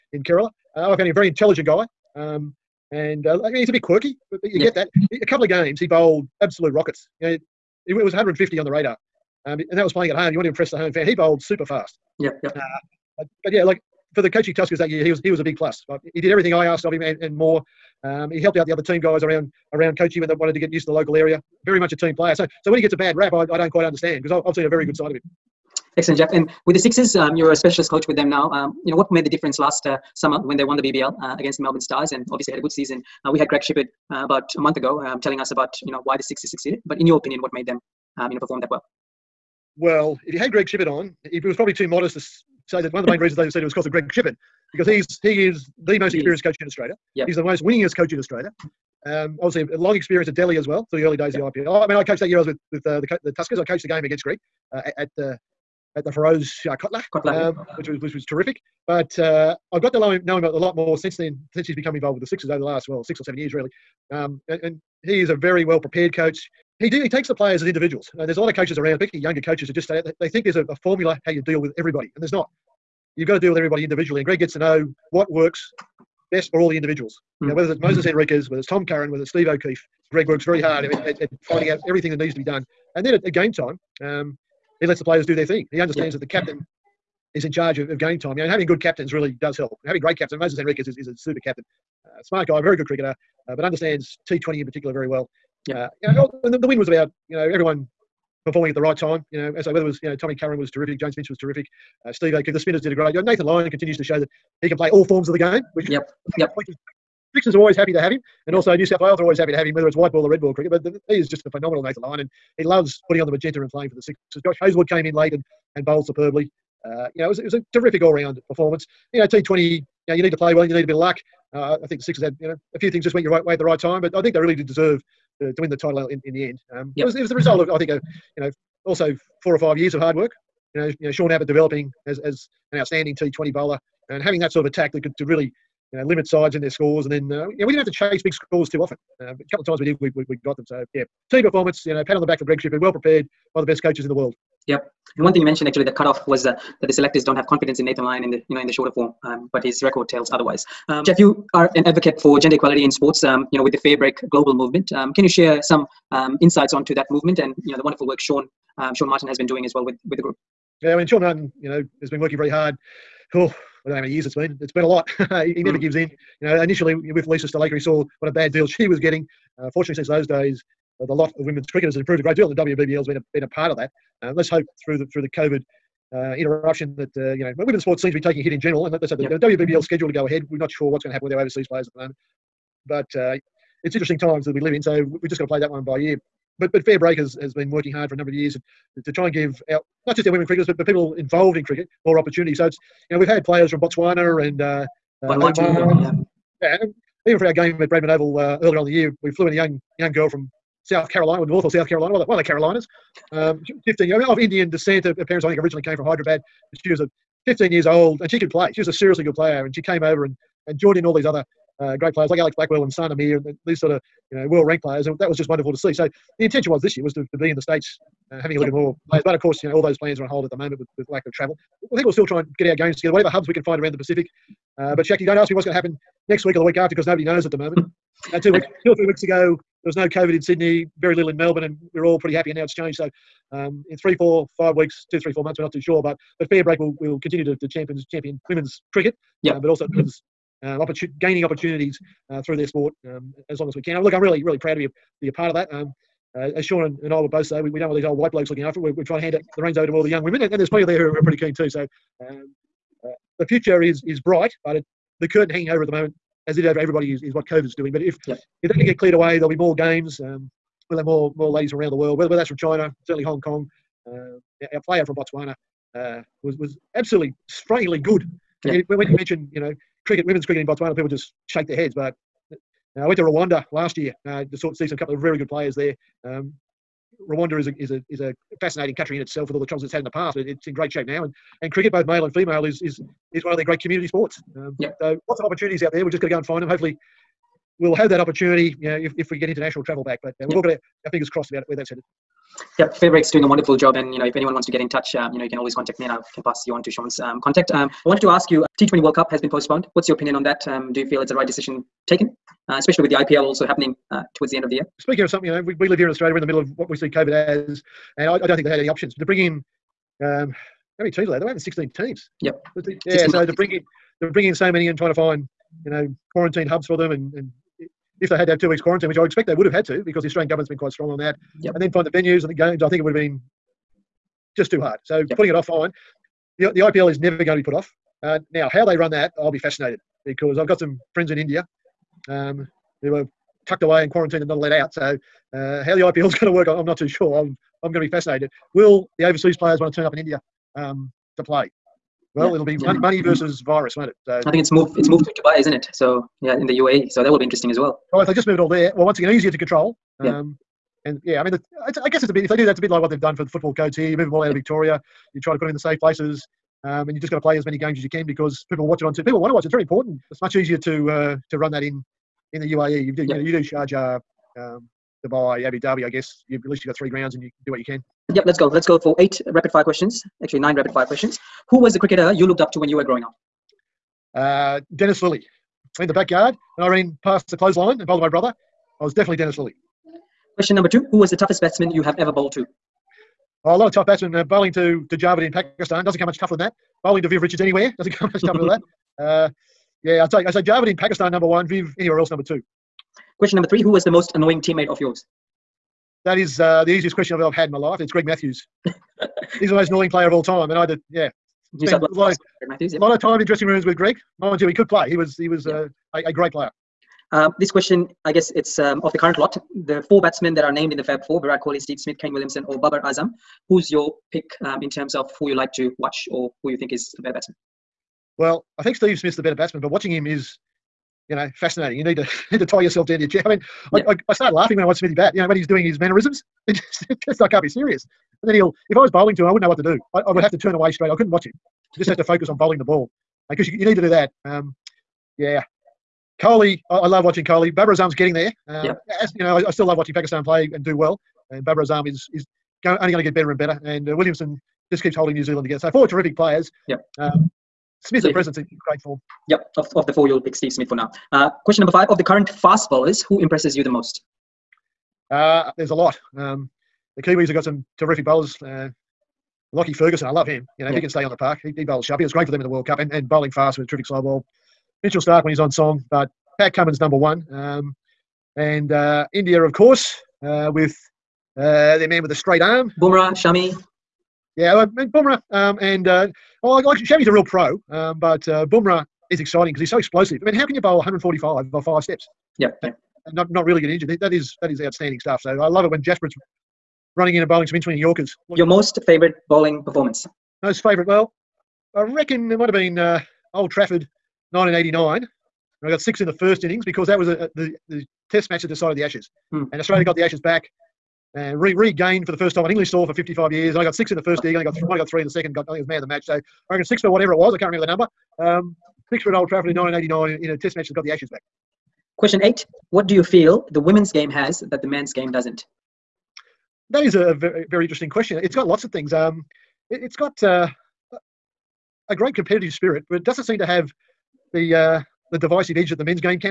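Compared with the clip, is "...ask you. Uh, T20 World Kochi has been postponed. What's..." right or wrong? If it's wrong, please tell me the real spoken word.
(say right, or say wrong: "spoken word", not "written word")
wrong: "Cup", not "Kochi".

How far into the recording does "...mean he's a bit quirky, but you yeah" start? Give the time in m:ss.
0:03.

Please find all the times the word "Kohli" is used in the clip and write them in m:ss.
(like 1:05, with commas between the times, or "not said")
6:51, 7:16.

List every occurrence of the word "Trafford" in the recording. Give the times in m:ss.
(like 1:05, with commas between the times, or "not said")
8:13, 8:29.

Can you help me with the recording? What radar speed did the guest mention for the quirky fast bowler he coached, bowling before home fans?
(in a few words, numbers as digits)
150.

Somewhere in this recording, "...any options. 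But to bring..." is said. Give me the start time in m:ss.
5:08.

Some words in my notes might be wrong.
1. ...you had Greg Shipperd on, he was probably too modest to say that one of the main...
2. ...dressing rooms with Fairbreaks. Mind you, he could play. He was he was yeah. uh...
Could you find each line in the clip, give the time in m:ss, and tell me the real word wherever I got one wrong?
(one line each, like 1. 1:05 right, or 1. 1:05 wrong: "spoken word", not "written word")
1. 0:40 right
2. 6:43 wrong: "Greg", not "Fairbreaks".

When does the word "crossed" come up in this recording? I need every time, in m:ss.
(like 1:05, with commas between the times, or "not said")
4:51.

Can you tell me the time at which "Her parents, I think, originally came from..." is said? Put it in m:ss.
3:25.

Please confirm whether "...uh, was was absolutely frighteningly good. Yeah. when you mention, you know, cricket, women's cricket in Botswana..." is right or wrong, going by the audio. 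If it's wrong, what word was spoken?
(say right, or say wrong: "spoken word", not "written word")
right.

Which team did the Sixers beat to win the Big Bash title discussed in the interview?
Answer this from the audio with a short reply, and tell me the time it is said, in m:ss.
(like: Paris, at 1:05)
Melbourne Stars, at 0:31.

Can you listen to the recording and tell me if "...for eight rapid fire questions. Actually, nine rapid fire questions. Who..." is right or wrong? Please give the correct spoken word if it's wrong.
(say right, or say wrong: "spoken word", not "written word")
right.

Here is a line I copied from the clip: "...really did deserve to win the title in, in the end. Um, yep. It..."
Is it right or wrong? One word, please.
right.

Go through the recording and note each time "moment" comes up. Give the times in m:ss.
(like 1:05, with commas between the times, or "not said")
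3:01, 3:40, 3:47, 4:15.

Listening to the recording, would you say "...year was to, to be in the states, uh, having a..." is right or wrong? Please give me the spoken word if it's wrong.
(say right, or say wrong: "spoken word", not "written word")
right.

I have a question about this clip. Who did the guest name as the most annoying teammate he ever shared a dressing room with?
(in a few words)
Greg Matthews.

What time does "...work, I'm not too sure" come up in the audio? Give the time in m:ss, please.
5:36.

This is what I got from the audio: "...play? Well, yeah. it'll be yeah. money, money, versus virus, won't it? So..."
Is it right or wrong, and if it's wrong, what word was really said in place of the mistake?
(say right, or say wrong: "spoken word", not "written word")
right.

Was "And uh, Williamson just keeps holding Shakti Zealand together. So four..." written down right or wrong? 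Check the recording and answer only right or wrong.
wrong.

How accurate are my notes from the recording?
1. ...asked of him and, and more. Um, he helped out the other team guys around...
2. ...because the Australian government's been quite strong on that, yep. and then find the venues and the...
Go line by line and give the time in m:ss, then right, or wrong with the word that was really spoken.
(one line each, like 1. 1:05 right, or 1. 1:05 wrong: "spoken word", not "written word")
1. 0:16 right
2. 5:20 right.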